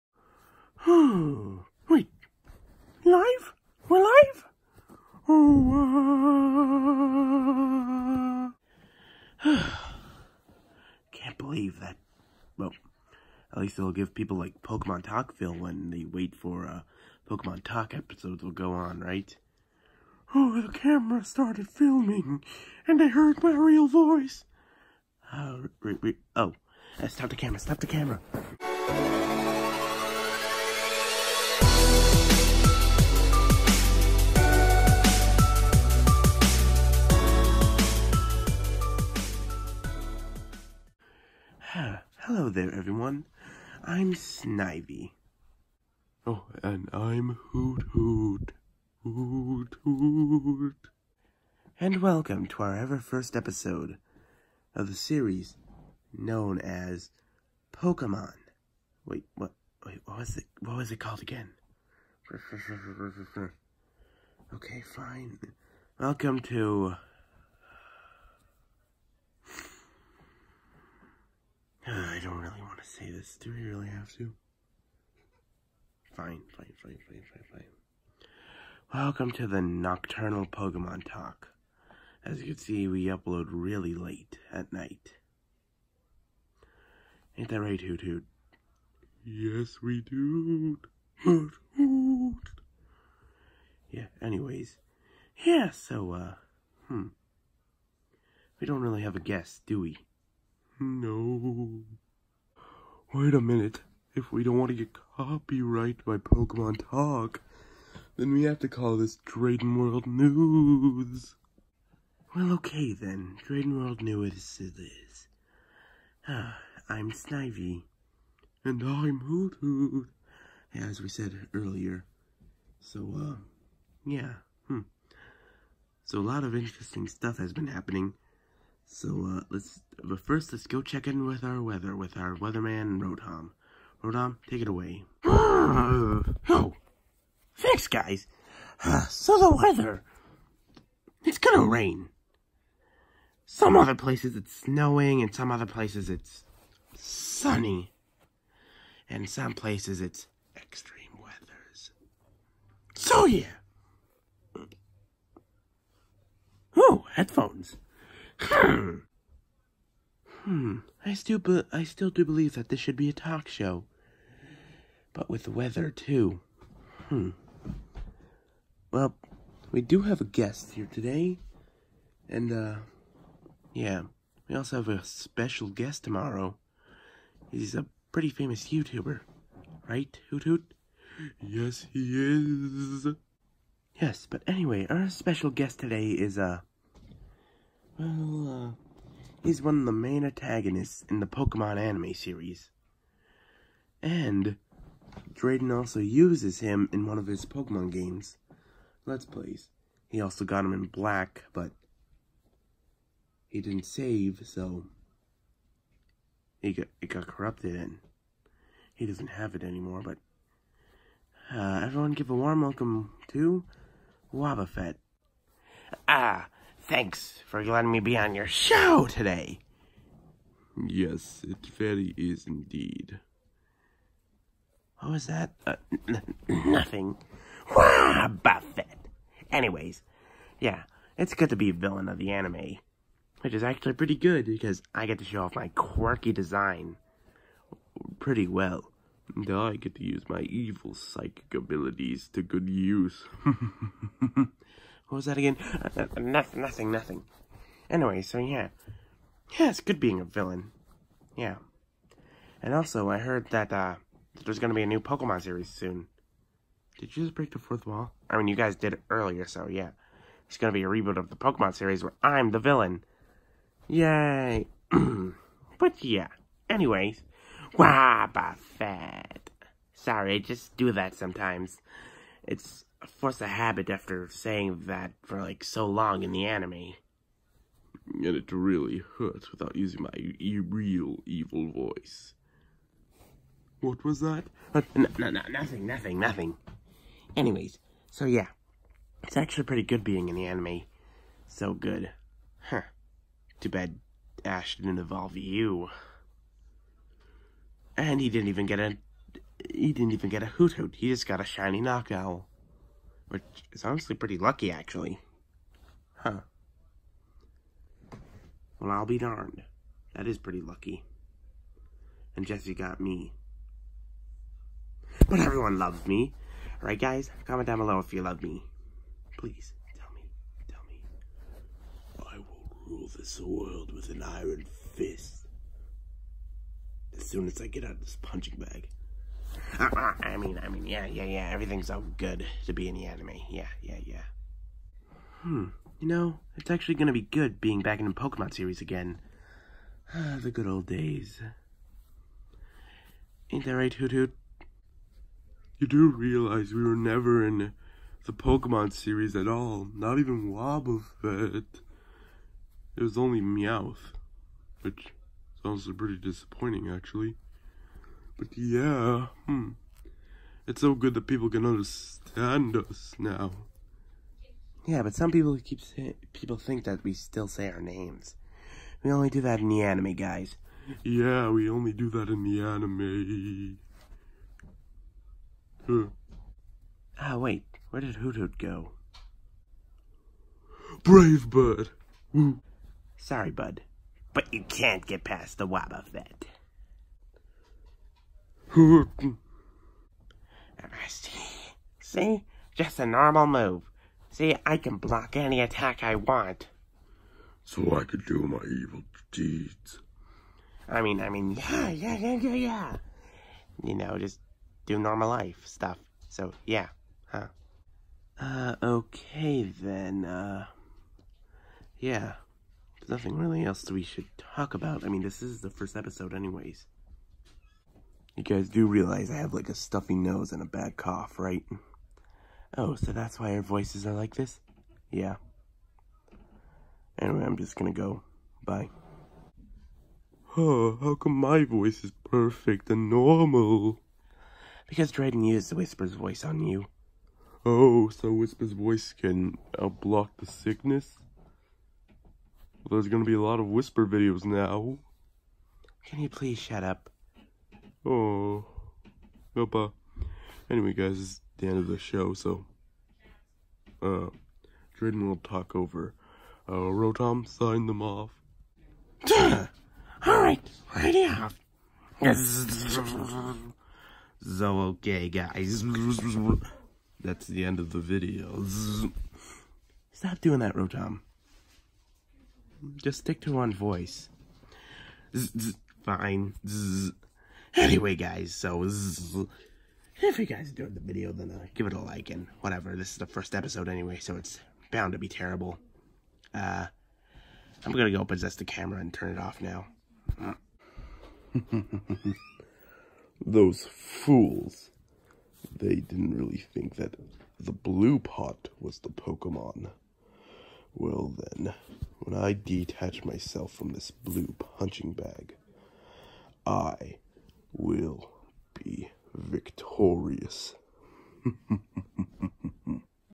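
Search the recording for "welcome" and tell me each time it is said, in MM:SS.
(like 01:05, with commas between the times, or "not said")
00:51, 01:05, 01:18, 03:32.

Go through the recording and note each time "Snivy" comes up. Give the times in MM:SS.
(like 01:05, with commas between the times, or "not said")
00:44, 01:57.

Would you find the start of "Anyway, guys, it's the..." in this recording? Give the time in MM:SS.
07:30.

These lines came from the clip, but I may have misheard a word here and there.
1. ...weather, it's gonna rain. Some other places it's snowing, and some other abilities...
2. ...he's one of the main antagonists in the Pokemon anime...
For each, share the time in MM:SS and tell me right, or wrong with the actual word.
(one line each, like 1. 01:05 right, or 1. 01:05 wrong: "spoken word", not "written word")
1. 02:19 wrong: "places", not "abilities"
2. 03:09 right.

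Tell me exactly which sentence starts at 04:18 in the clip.
I mean, you guys did it earlier, so yeah.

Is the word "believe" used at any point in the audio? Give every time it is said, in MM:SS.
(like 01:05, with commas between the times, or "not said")
00:11, 02:42.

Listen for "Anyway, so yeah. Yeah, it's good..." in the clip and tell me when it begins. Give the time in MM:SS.
04:07.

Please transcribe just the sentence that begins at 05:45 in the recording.
You do realize we were never in the Pokemon series at all.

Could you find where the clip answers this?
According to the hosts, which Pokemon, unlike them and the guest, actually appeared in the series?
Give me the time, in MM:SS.
05:53.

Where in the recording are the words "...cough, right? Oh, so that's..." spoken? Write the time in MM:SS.
07:00.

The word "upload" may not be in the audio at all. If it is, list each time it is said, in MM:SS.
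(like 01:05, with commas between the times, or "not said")
01:23.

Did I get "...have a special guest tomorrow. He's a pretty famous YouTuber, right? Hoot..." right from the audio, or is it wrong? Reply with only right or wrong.
right.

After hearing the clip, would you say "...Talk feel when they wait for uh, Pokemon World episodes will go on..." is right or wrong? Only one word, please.
wrong.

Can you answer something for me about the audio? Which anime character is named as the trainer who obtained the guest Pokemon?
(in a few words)
Jessie.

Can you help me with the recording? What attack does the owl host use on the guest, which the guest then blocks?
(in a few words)
Brave Bird.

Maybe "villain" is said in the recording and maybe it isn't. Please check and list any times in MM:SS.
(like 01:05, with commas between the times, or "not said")
03:51, 04:10, 04:22.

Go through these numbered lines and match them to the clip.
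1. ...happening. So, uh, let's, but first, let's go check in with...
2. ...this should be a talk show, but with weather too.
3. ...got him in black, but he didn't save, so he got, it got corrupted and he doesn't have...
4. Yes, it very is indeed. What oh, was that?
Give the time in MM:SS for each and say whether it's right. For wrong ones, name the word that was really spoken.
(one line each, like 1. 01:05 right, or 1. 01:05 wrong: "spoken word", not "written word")
1. 02:07 right
2. 02:42 right
3. 03:20 right
4. 03:40 right.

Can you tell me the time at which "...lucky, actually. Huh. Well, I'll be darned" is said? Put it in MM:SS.
05:04.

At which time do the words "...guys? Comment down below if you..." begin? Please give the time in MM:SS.
05:16.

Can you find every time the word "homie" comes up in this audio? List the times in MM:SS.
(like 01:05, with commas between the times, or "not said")
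not said.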